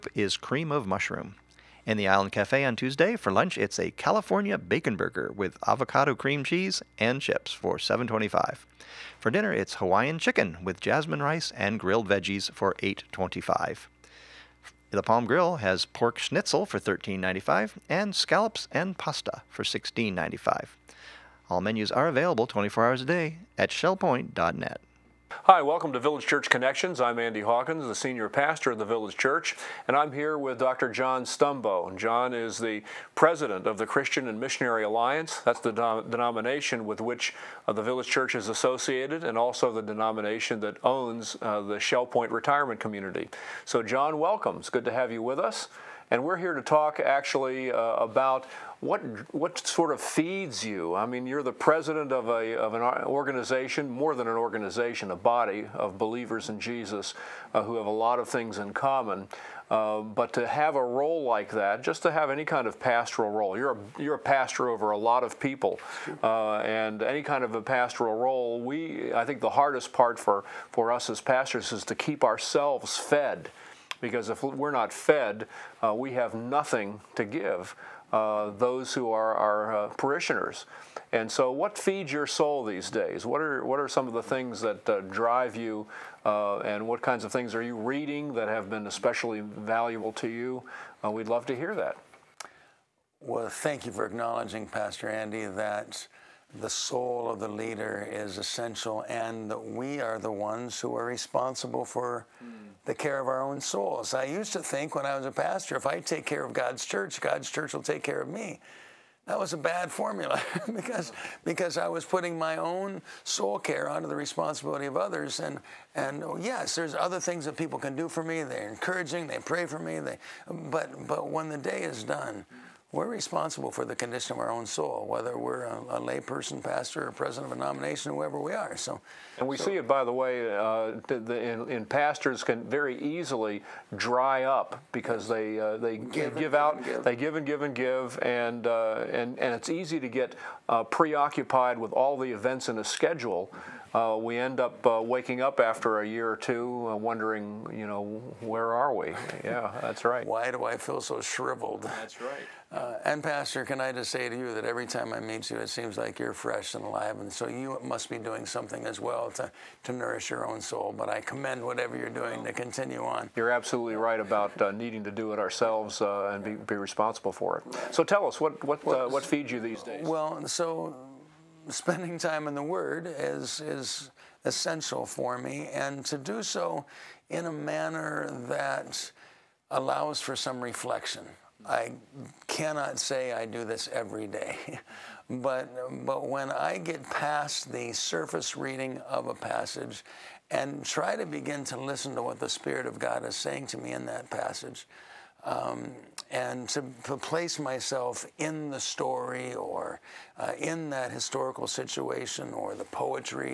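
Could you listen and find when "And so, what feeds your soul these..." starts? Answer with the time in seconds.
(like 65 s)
81 s.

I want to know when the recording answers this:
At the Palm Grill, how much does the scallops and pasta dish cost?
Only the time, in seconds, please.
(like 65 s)
19 s.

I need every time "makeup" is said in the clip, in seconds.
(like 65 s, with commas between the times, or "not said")
not said.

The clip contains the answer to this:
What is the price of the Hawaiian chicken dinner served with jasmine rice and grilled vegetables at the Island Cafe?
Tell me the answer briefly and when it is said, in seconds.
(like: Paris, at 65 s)
$8.25, at 12 s.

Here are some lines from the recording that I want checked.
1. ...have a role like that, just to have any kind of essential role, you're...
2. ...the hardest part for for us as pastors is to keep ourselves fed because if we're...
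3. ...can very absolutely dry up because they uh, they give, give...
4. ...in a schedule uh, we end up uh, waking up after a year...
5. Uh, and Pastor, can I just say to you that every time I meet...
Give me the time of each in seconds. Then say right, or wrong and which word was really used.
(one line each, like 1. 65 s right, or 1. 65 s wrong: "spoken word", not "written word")
1. 60 s wrong: "pastoral", not "essential"
2. 69 s right
3. 132 s wrong: "easily", not "absolutely"
4. 142 s right
5. 152 s right.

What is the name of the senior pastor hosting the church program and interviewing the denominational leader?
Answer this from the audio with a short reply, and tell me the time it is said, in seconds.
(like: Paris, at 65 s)
Andy Hawkins, at 27 s.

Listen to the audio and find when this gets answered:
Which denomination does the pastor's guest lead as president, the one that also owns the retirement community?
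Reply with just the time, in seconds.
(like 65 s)
33 s.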